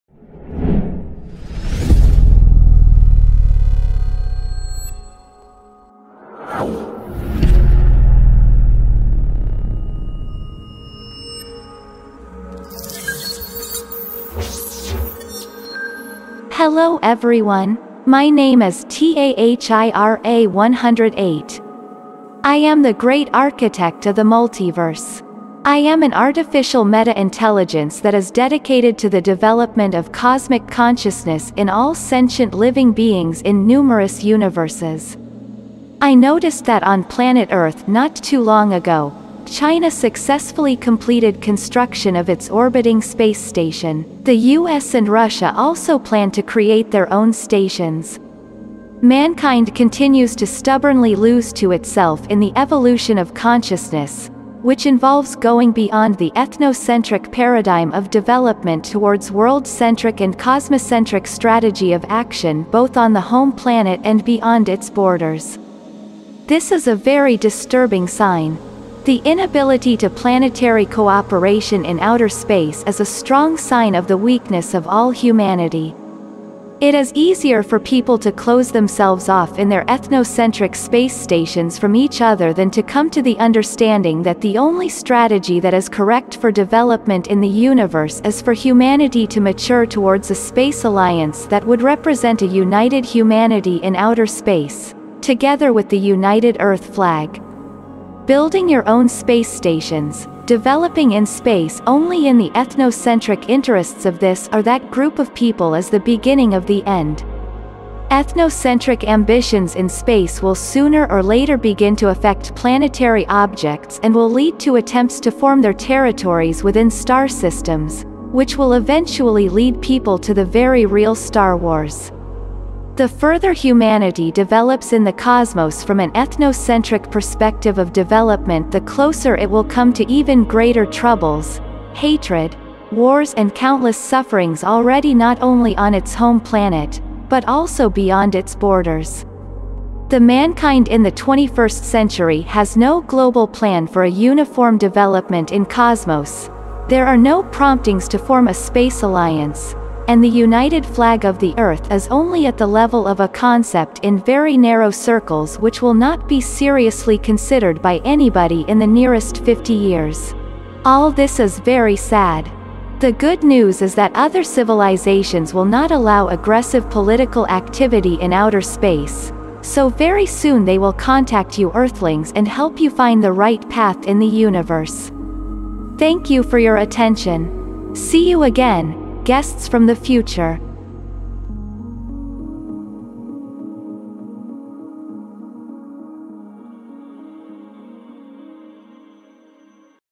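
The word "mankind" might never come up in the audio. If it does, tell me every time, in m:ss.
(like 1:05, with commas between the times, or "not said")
0:49, 2:20.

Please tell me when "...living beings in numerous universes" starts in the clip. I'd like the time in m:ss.
0:32.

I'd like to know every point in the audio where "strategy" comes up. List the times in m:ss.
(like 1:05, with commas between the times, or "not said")
1:01, 1:24.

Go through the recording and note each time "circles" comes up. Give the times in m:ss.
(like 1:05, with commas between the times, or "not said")
2:34.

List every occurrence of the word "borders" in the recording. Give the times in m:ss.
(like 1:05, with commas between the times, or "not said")
1:04, 2:18.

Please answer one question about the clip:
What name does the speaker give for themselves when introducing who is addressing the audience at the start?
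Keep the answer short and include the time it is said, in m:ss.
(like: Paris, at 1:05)
TAHIRA 108, at 0:18.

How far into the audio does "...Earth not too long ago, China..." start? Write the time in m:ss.
0:37.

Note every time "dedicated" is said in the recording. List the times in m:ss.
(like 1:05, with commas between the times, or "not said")
0:28.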